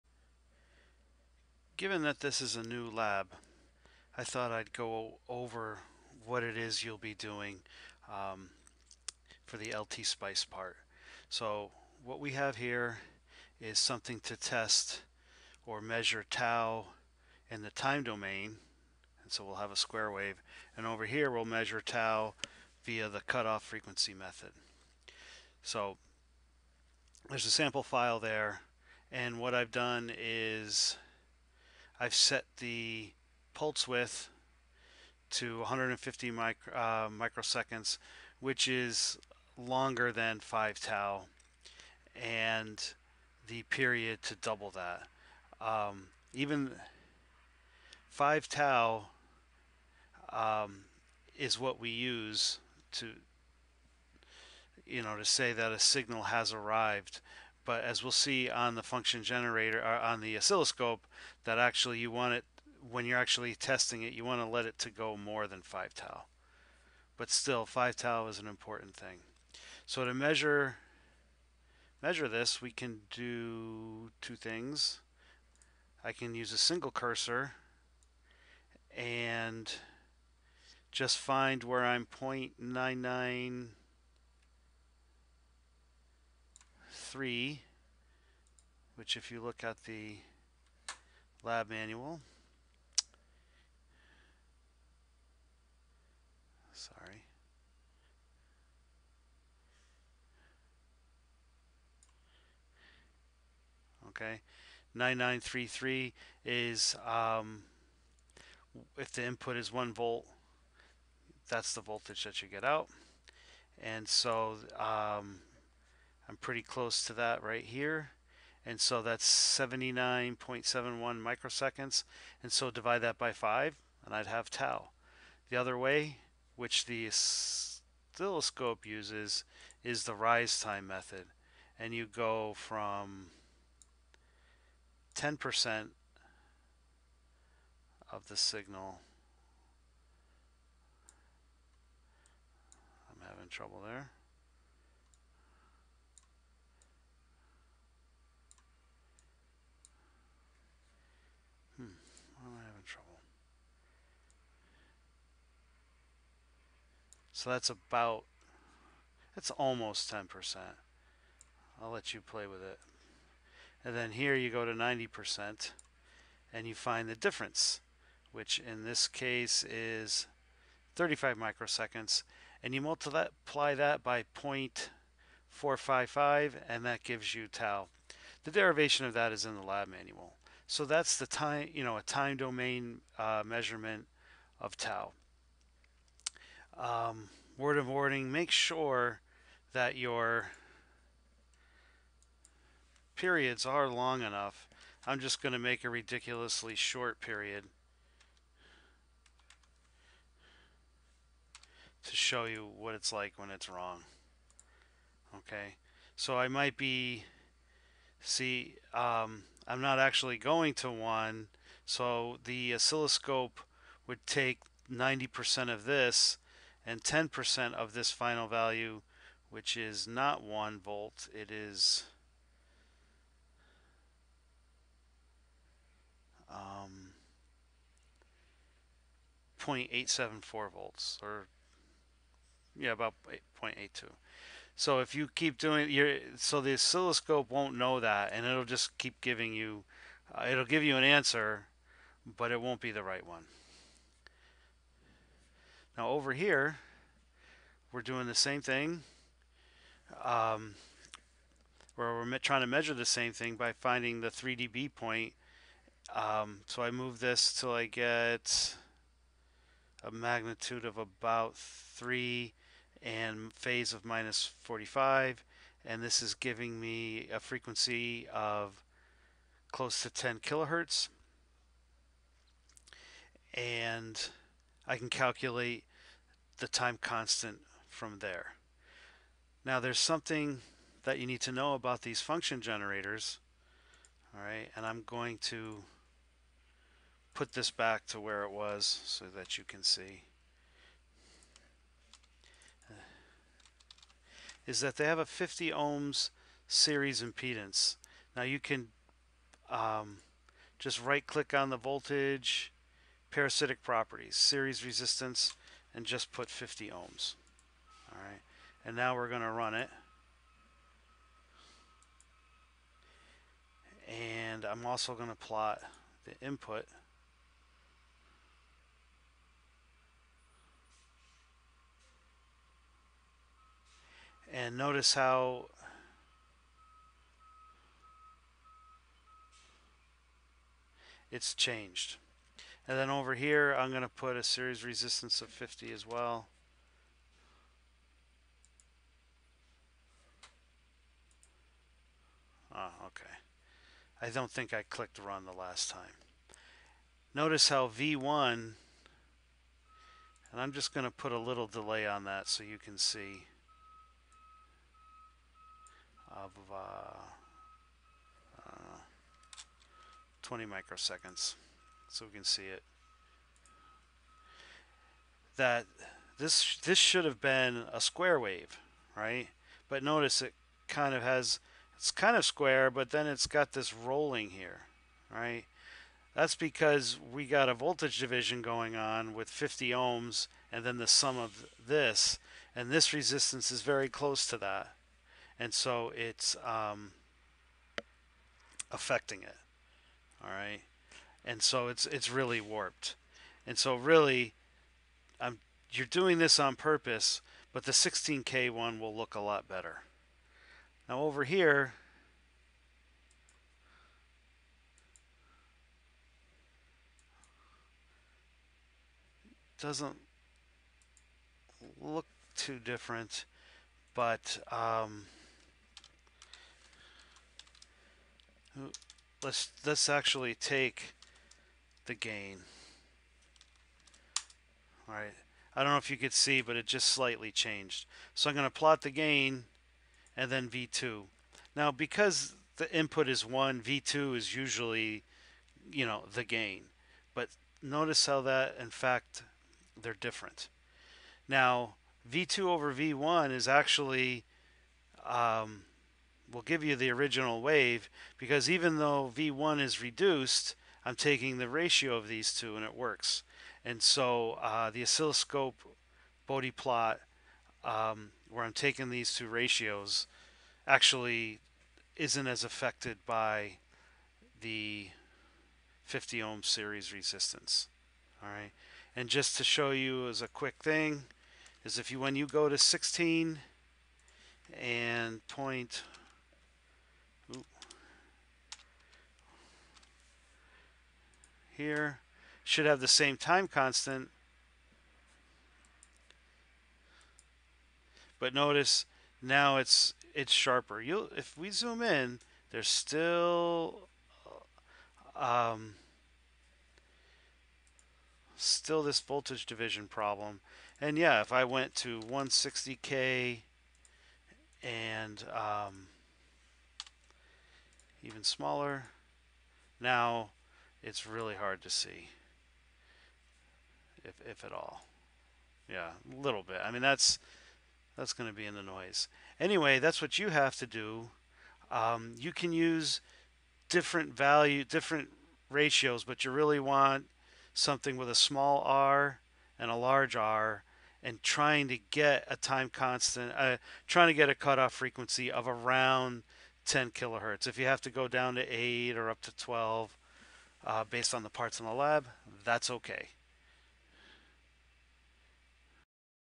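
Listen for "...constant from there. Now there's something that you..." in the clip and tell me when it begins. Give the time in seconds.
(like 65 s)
277 s.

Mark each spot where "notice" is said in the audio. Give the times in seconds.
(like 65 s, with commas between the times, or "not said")
324 s, 347 s, 370 s, 437 s, 488 s.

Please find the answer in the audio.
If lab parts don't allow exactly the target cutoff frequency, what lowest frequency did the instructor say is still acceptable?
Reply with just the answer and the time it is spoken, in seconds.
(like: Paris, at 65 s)
8 kilohertz, at 538 s.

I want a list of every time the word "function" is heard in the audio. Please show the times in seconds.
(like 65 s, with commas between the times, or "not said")
58 s, 282 s.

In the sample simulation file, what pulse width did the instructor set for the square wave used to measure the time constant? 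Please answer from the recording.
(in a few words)
150 microseconds.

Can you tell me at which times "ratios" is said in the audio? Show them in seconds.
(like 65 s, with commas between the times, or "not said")
451 s, 459 s, 525 s.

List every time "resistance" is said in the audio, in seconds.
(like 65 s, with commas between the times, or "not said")
304 s, 334 s, 383 s, 467 s.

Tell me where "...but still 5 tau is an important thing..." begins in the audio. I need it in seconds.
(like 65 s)
67 s.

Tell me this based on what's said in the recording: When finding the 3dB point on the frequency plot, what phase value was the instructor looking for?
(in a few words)
minus 45.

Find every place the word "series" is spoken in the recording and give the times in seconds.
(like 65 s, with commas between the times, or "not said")
296 s, 304 s, 334 s, 466 s.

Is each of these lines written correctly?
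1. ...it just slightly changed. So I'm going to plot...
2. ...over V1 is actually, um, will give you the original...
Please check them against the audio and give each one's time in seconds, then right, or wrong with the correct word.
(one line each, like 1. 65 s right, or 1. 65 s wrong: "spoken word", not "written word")
1. 426 s right
2. 442 s right.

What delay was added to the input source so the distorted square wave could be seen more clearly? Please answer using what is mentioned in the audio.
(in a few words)
20 microseconds.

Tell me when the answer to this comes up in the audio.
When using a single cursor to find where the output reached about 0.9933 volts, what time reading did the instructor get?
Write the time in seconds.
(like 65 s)
119 s.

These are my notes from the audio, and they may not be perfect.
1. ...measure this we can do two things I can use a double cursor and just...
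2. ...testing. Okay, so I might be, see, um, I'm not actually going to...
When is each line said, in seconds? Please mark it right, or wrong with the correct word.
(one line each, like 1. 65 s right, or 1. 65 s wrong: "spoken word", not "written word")
1. 72 s wrong: "single", not "double"
2. 203 s wrong: "wrong", not "testing".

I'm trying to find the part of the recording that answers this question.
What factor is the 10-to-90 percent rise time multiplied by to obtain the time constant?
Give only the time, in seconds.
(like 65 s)
174 s.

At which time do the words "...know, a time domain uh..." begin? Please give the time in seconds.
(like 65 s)
181 s.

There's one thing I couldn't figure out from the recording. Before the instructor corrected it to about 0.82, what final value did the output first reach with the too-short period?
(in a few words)
0.874 volts.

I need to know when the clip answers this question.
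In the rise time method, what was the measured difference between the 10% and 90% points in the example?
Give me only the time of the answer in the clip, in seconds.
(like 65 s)
170 s.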